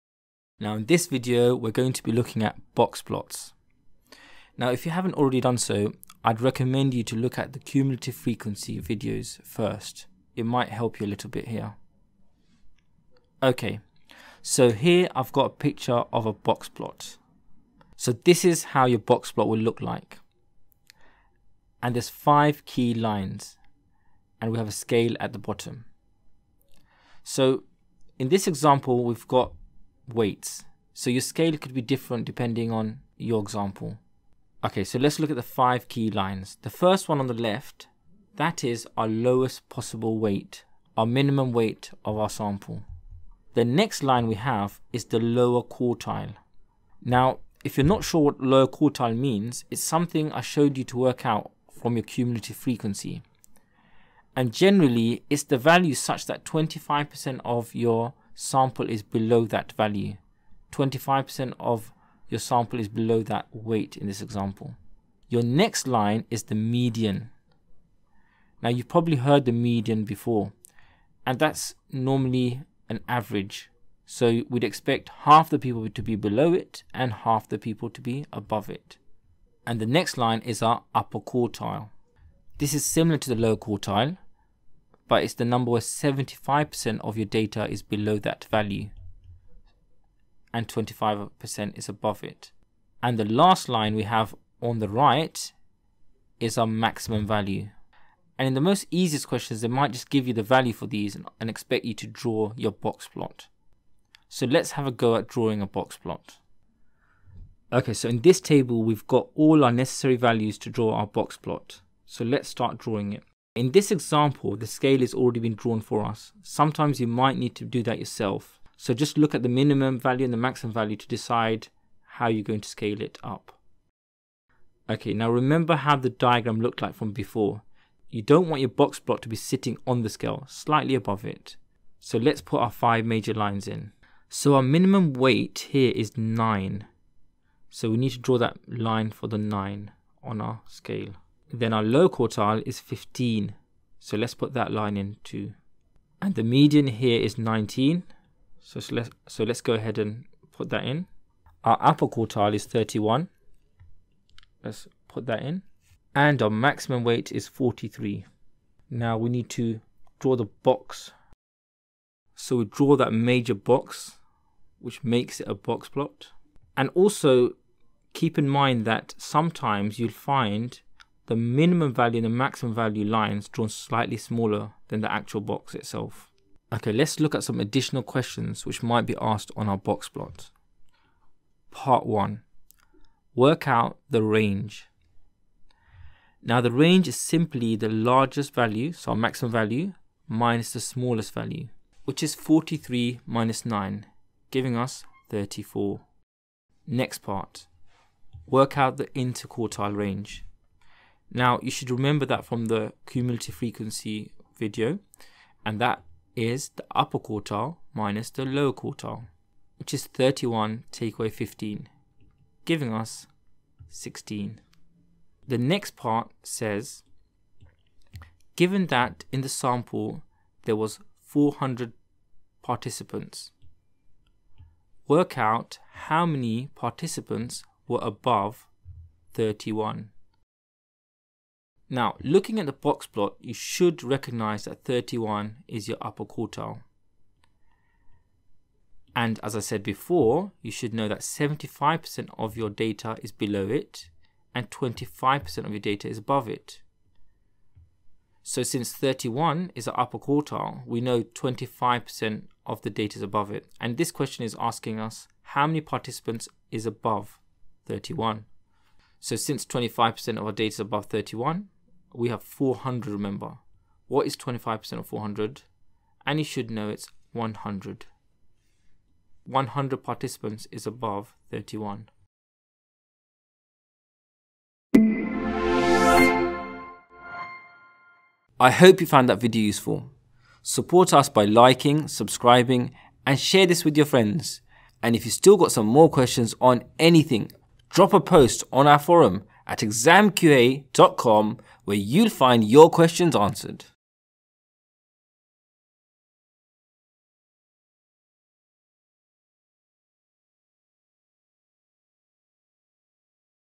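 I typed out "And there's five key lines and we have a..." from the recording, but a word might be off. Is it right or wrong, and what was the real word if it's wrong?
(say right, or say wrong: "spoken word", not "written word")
right.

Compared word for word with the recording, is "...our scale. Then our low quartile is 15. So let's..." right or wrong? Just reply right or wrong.
right.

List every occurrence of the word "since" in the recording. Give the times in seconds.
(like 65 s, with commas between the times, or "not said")
248 s, 259 s.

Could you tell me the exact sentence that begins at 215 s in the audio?
The next part says given that in the sample there was 400 participants work out how many participants were above 31.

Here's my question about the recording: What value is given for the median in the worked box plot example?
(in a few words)
19.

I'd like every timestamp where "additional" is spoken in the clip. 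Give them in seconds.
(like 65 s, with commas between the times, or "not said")
177 s.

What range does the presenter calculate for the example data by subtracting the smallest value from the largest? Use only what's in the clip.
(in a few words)
34.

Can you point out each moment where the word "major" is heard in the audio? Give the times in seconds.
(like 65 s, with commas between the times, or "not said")
133 s, 163 s.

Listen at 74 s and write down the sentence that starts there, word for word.
So we'd expect half the people to be below it and half the people to be above it.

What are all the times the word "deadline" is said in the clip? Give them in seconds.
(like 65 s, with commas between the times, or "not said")
not said.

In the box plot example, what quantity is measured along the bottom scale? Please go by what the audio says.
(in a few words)
Weights.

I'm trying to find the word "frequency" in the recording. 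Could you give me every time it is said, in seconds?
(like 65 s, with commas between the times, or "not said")
8 s, 52 s, 203 s.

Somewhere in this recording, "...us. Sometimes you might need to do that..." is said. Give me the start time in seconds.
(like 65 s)
116 s.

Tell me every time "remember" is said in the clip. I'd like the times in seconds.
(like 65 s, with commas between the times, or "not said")
125 s, 201 s, 263 s.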